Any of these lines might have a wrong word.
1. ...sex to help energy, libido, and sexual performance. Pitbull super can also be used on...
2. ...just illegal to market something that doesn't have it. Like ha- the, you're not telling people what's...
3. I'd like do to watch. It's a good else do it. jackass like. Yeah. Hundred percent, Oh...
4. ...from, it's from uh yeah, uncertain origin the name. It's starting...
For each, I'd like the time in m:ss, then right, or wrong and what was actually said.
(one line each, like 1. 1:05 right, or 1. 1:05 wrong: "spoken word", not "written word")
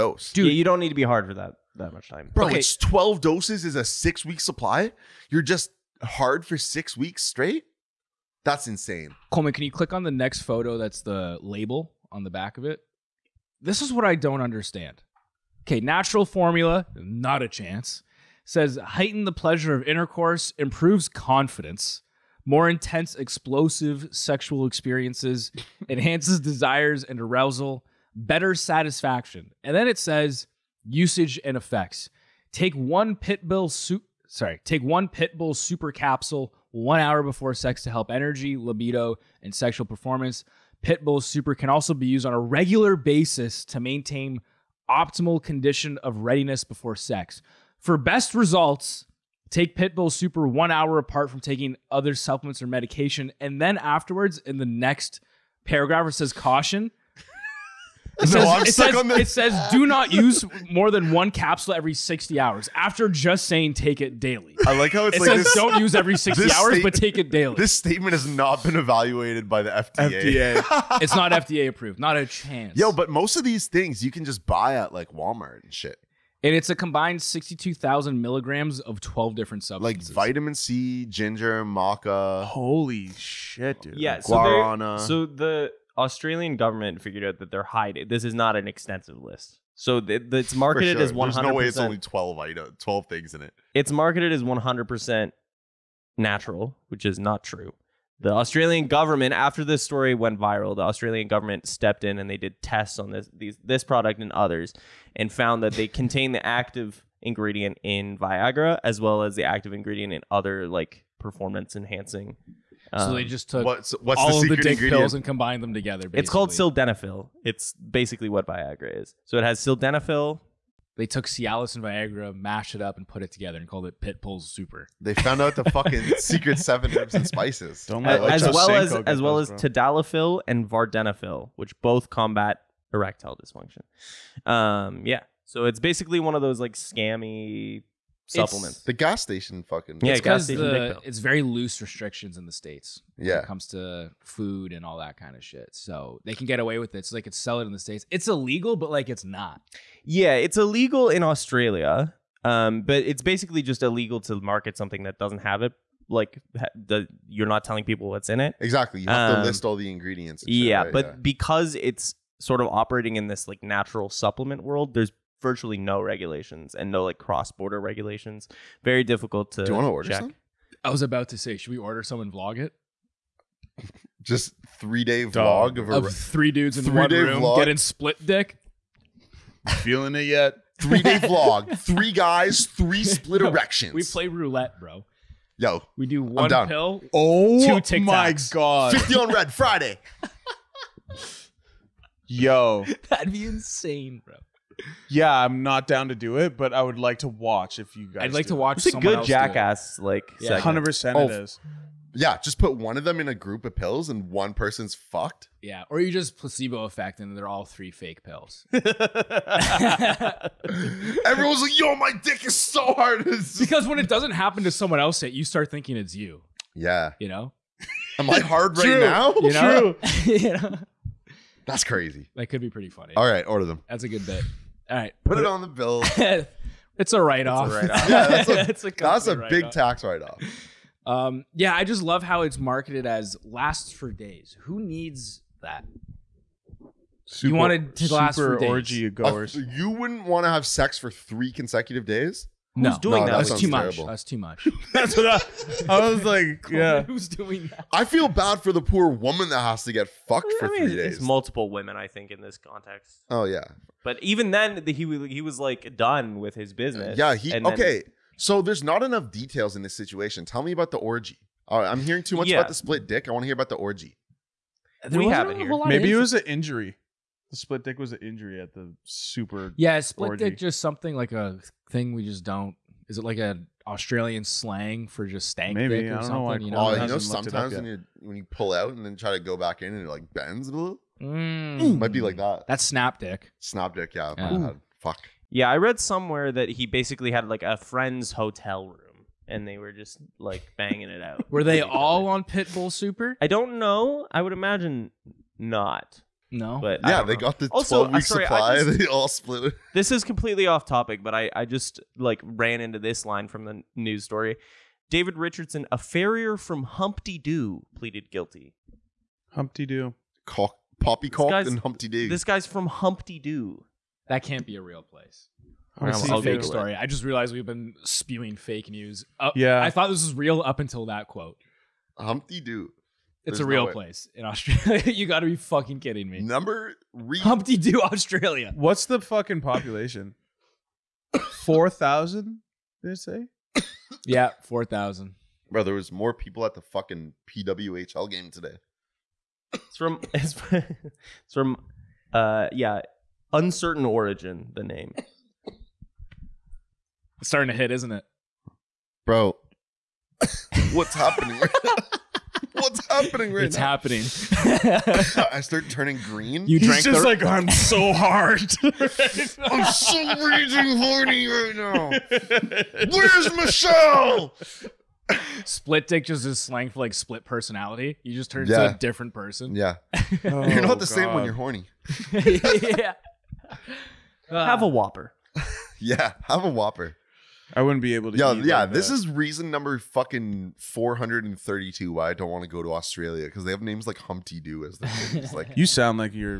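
1. 0:37 right
2. 2:33 right
3. 3:18 right
4. 5:40 right.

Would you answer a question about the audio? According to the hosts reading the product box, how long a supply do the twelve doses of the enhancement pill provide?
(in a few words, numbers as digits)
6 weeks.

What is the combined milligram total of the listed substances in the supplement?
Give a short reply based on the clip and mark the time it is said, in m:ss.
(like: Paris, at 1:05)
62,000 milligrams, at 1:17.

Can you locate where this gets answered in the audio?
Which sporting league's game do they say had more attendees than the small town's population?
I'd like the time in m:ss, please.
5:37.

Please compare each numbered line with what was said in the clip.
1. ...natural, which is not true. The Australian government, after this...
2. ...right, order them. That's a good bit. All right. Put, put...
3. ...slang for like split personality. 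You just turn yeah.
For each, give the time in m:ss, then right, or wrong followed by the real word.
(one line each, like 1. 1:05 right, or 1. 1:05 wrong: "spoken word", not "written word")
1. 1:36 right
2. 3:43 right
3. 6:06 right.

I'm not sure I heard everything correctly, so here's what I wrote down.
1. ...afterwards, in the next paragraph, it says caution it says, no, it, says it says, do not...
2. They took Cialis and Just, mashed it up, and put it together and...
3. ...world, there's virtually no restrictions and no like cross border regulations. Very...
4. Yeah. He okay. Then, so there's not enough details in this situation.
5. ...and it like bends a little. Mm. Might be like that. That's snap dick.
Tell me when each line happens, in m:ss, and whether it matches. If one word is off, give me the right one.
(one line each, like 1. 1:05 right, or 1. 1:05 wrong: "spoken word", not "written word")
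1. 0:53 right
2. 2:00 wrong: "Viagra", not "Just"
3. 2:44 wrong: "regulations", not "restrictions"
4. 4:17 right
5. 4:39 right.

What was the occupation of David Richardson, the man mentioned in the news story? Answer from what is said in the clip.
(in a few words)
farrier.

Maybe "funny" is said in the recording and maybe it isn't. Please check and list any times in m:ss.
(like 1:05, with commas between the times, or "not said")
3:42.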